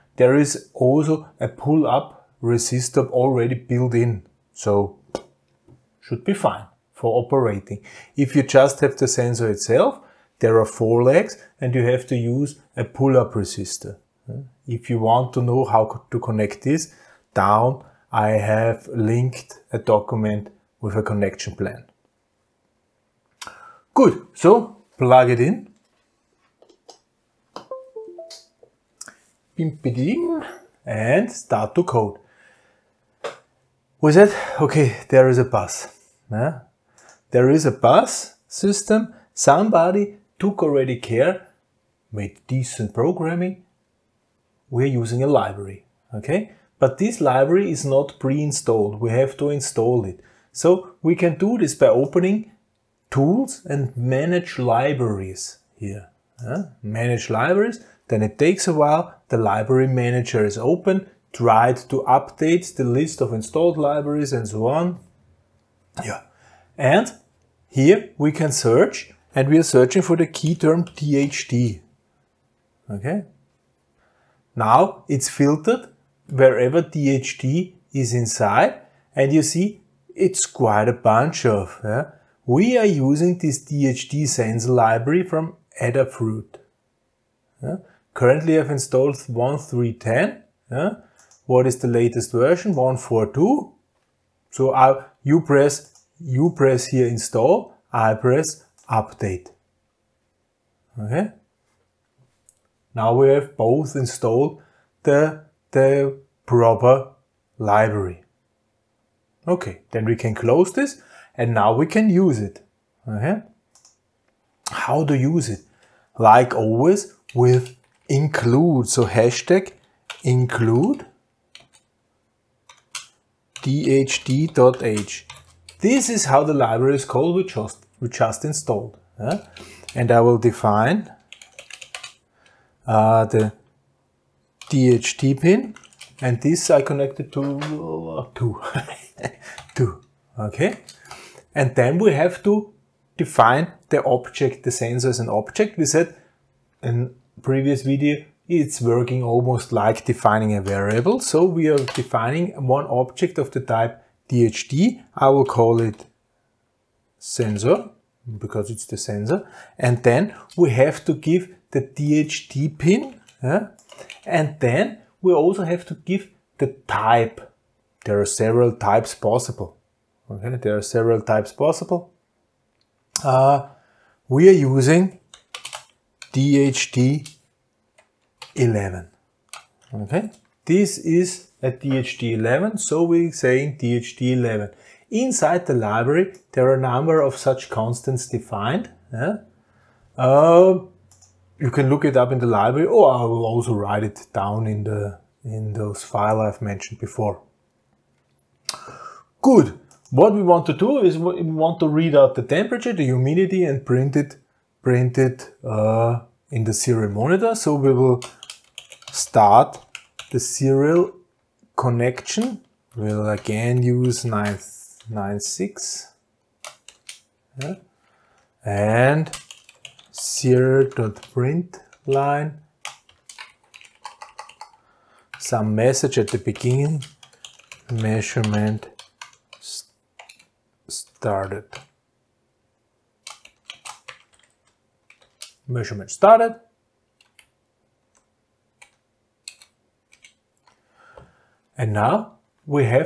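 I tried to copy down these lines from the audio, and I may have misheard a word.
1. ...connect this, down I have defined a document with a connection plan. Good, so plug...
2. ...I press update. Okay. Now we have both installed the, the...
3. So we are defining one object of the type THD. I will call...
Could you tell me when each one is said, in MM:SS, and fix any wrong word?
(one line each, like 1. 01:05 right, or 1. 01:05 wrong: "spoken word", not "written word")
1. 00:16 wrong: "linked", not "defined"
2. 01:37 right
3. 02:31 wrong: "DHT", not "THD".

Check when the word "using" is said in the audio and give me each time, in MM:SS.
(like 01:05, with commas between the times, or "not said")
00:45, 01:22, 02:54.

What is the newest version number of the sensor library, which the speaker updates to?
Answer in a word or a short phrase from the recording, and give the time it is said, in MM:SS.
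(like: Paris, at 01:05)
1.4.2, at 01:32.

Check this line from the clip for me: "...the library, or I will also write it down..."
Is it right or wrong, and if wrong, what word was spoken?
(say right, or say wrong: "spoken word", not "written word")
right.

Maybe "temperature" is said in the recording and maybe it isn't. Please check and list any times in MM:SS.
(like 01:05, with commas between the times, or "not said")
03:22.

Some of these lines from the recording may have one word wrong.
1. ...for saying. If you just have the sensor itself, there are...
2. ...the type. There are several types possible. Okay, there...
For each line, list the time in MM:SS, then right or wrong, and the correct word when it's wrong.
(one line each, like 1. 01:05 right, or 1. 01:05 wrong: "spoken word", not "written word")
1. 00:06 wrong: "operating", not "saying"
2. 02:46 right.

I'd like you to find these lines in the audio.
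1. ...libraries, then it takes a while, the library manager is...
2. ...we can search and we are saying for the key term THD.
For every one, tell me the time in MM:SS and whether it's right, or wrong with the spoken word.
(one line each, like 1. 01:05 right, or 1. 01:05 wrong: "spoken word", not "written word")
1. 00:57 right
2. 01:08 wrong: "searching", not "saying".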